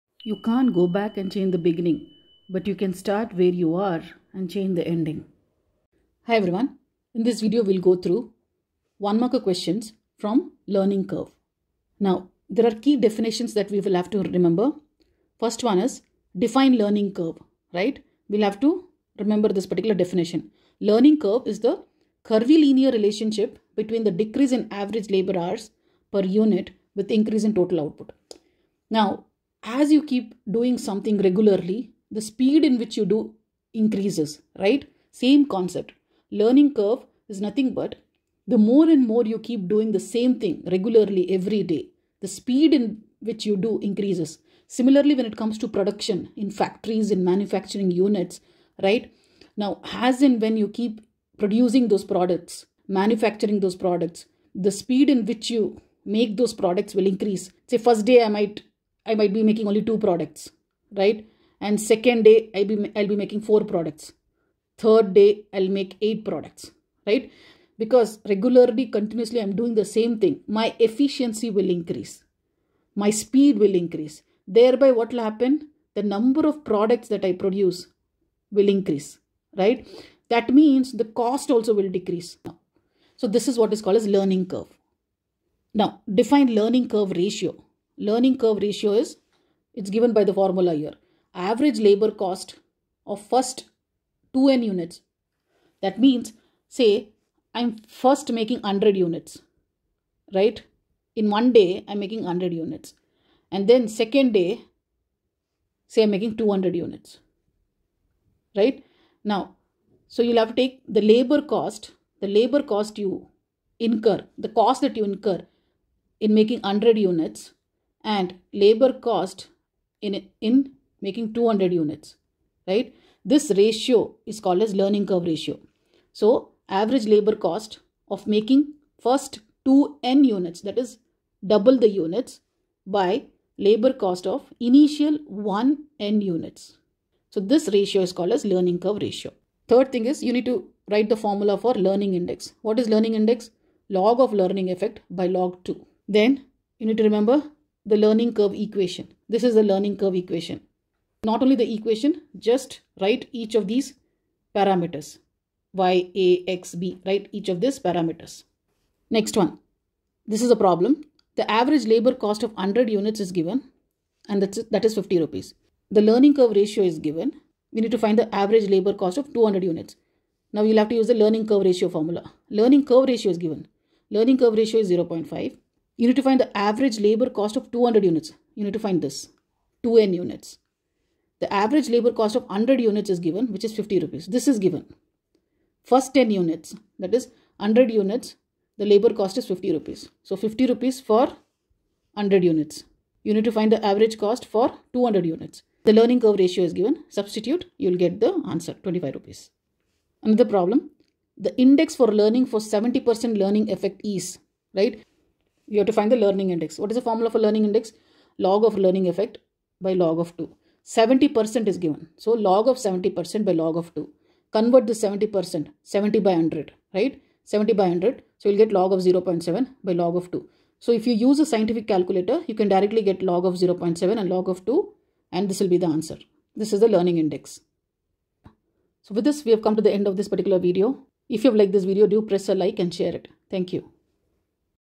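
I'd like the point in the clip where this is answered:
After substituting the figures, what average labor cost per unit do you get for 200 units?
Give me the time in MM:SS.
03:18.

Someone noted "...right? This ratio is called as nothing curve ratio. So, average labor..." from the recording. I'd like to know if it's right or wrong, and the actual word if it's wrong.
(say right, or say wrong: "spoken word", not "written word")
wrong: "learning", not "nothing".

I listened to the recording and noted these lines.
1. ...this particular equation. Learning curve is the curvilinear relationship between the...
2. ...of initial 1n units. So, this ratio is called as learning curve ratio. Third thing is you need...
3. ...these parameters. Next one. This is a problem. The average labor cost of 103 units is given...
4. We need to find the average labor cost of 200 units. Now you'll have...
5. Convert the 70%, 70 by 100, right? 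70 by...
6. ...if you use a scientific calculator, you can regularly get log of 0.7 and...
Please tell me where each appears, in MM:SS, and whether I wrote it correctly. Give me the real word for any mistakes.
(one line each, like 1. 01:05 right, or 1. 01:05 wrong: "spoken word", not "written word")
1. 00:19 wrong: "definition", not "equation"
2. 02:14 right
3. 02:37 wrong: "100", not "103"
4. 02:47 right
5. 03:34 right
6. 03:40 wrong: "directly", not "regularly".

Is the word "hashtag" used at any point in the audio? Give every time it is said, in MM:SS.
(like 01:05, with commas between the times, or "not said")
not said.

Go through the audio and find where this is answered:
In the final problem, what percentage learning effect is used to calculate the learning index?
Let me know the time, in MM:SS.
03:22.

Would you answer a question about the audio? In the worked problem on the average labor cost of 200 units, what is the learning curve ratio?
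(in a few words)
0.5.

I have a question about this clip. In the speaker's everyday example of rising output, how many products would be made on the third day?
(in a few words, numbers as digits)
8.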